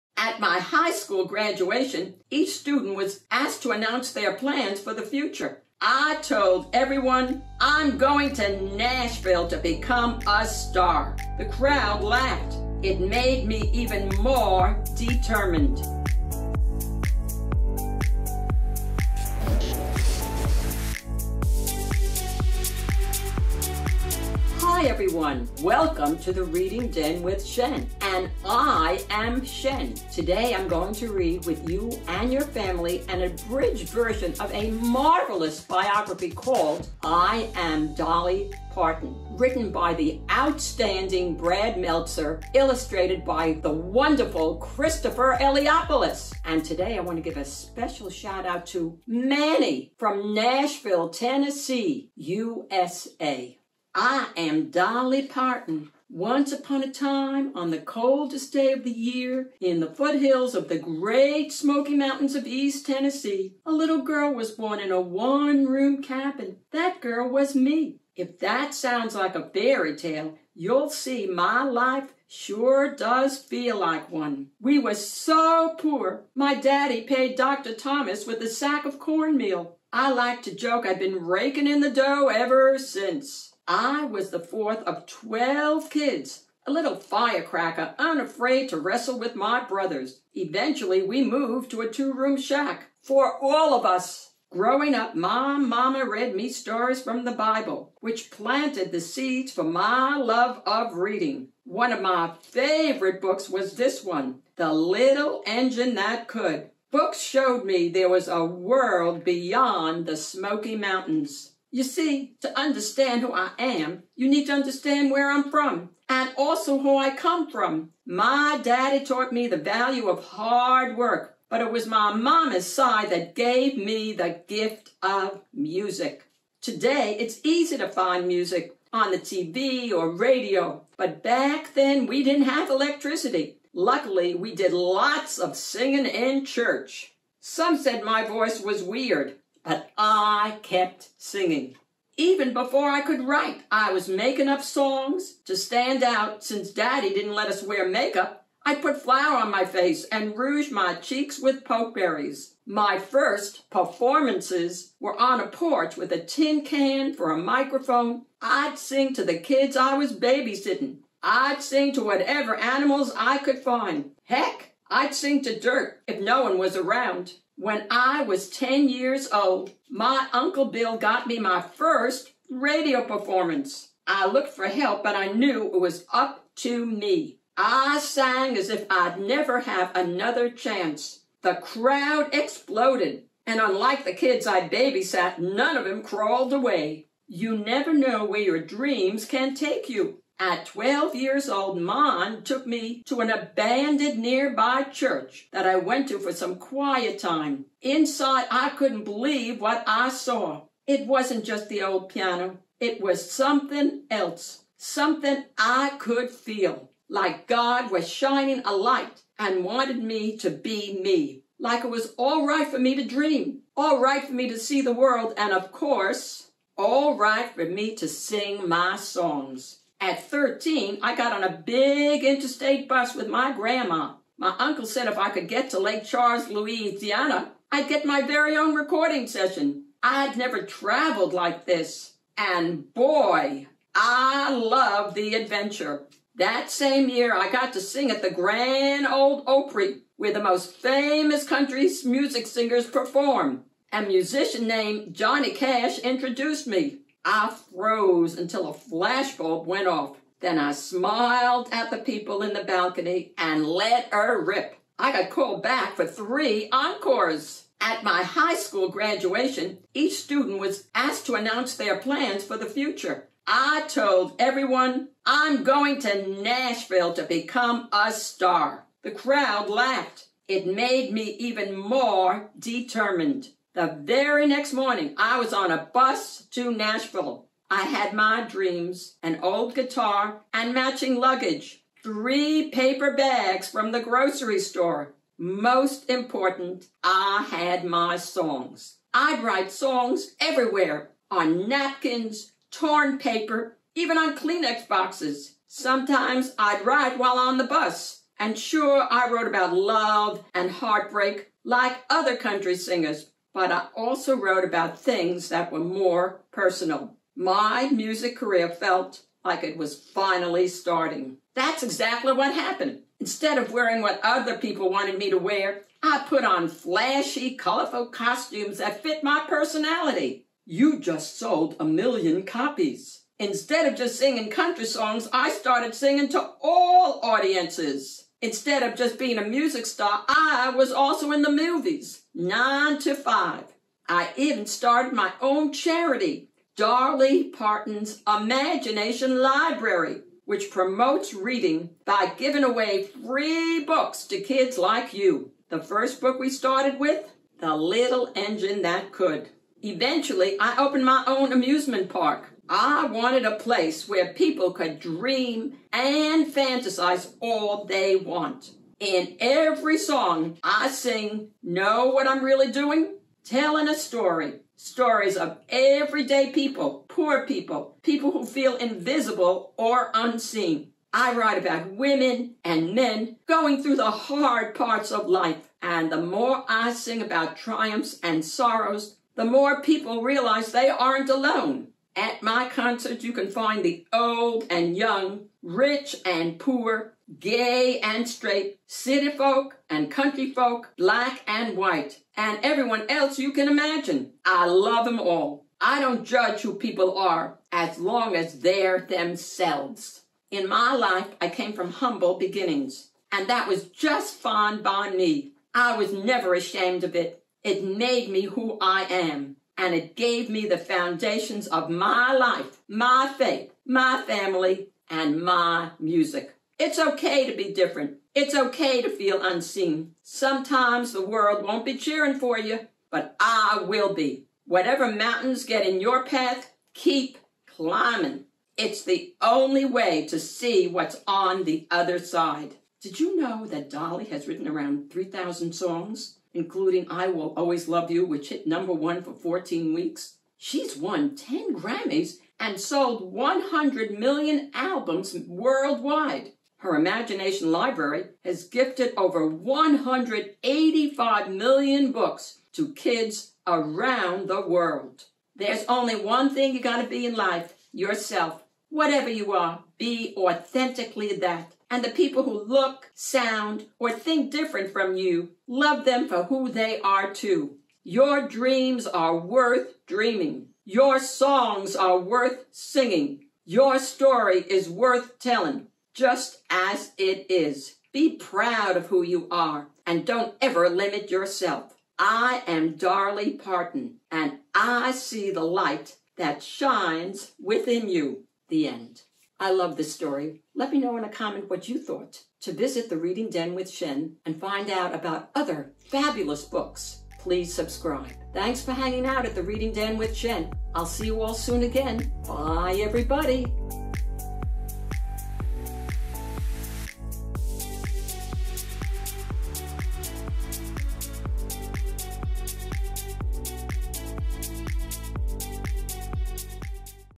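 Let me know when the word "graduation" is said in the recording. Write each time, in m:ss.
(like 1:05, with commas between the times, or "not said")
0:01, 4:18.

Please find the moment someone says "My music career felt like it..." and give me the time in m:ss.
5:07.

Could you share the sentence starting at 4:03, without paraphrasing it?
A musician named Johnny Cash introduced me.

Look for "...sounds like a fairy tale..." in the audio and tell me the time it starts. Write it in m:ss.
1:08.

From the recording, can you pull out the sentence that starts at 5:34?
I even started my own charity, Dolly Parton's Imagination Library, which promotes reading by giving away free books to kids like you.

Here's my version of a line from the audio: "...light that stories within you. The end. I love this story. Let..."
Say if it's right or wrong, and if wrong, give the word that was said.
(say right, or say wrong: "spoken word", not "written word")
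wrong: "shines", not "stories".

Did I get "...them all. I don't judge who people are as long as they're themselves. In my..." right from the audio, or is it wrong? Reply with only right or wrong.
right.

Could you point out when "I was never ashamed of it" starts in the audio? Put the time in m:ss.
6:45.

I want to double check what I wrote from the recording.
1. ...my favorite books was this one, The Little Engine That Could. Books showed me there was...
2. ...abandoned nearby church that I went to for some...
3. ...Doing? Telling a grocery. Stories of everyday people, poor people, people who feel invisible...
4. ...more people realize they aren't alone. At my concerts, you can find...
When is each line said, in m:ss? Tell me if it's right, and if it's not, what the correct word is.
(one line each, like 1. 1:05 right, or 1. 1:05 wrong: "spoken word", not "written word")
1. 1:42 right
2. 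3:13 right
3. 6:02 wrong: "story", not "grocery"
4. 6:19 right.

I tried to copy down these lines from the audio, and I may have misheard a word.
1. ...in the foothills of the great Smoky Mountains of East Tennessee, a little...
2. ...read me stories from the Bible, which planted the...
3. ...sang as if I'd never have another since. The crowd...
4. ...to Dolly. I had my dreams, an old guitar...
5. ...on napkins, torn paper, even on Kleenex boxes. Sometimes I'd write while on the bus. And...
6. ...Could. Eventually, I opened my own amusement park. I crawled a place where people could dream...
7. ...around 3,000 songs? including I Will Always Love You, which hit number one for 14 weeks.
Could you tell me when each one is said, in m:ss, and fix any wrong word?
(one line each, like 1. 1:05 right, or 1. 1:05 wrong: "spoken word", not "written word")
1. 0:59 right
2. 1:36 right
3. 2:57 wrong: "chance", not "since"
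4. 4:36 wrong: "Nashville", not "Dolly"
5. 4:51 right
6. 5:49 wrong: "wanted", not "crawled"
7. 7:14 right.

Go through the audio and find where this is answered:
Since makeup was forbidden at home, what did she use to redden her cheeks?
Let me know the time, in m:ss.
2:31.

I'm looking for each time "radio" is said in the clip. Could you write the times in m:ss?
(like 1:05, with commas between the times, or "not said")
2:10, 2:52.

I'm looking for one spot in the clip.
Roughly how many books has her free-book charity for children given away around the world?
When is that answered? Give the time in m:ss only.
7:29.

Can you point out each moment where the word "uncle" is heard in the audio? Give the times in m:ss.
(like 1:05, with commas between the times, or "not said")
2:50, 3:44.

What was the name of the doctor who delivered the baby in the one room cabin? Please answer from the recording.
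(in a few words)
Dr. Thomas.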